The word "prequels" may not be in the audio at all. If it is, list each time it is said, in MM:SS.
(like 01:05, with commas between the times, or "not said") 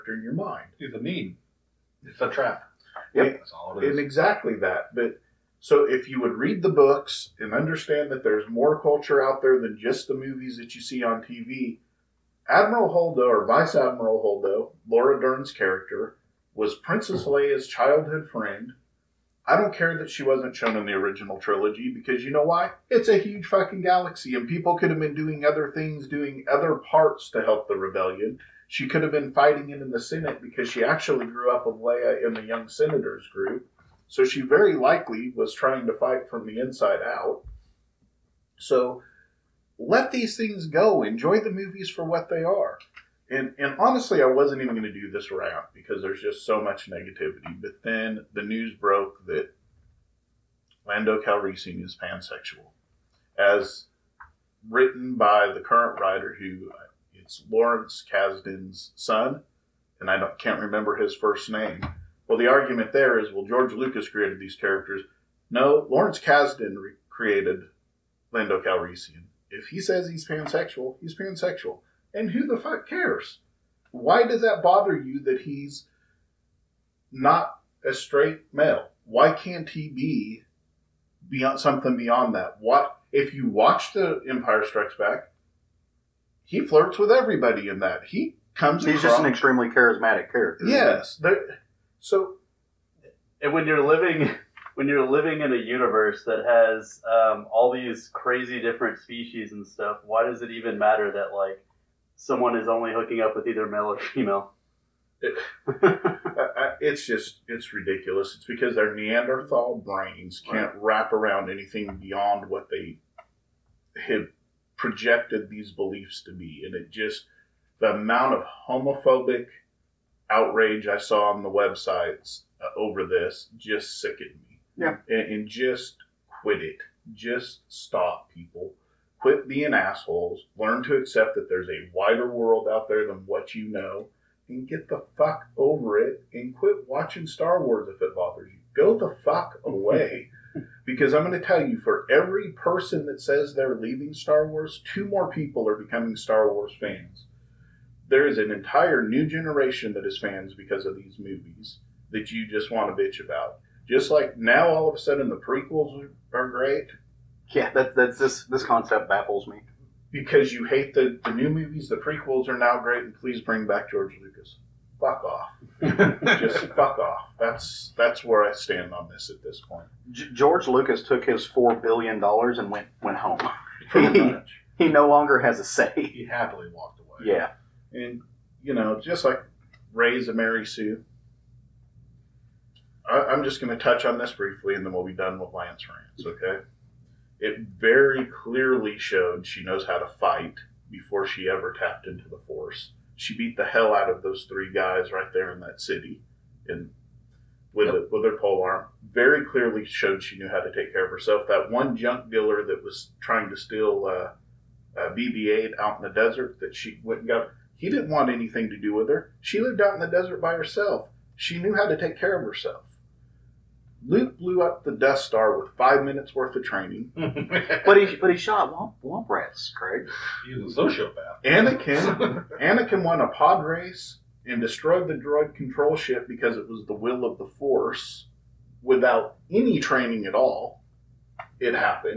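02:35, 02:41.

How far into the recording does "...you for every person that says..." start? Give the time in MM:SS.
02:21.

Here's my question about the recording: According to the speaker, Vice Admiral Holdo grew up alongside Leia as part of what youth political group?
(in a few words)
Young Senators group.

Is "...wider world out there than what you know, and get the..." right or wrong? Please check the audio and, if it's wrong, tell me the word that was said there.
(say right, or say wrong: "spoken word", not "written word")
right.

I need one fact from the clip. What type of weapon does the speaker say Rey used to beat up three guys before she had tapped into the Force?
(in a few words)
pole arm.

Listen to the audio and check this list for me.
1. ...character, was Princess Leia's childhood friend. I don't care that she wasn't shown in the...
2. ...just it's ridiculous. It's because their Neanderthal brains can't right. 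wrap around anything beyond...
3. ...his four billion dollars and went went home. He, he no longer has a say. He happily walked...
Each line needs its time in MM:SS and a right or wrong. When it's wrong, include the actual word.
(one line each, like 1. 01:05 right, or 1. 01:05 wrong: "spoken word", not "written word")
1. 00:15 right
2. 01:47 right
3. 02:51 right.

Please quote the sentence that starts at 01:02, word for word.
Well, the argument there is, well, George Lucas created these characters.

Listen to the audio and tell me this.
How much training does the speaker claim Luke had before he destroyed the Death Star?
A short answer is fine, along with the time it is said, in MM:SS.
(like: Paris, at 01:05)
5 minutes, at 03:35.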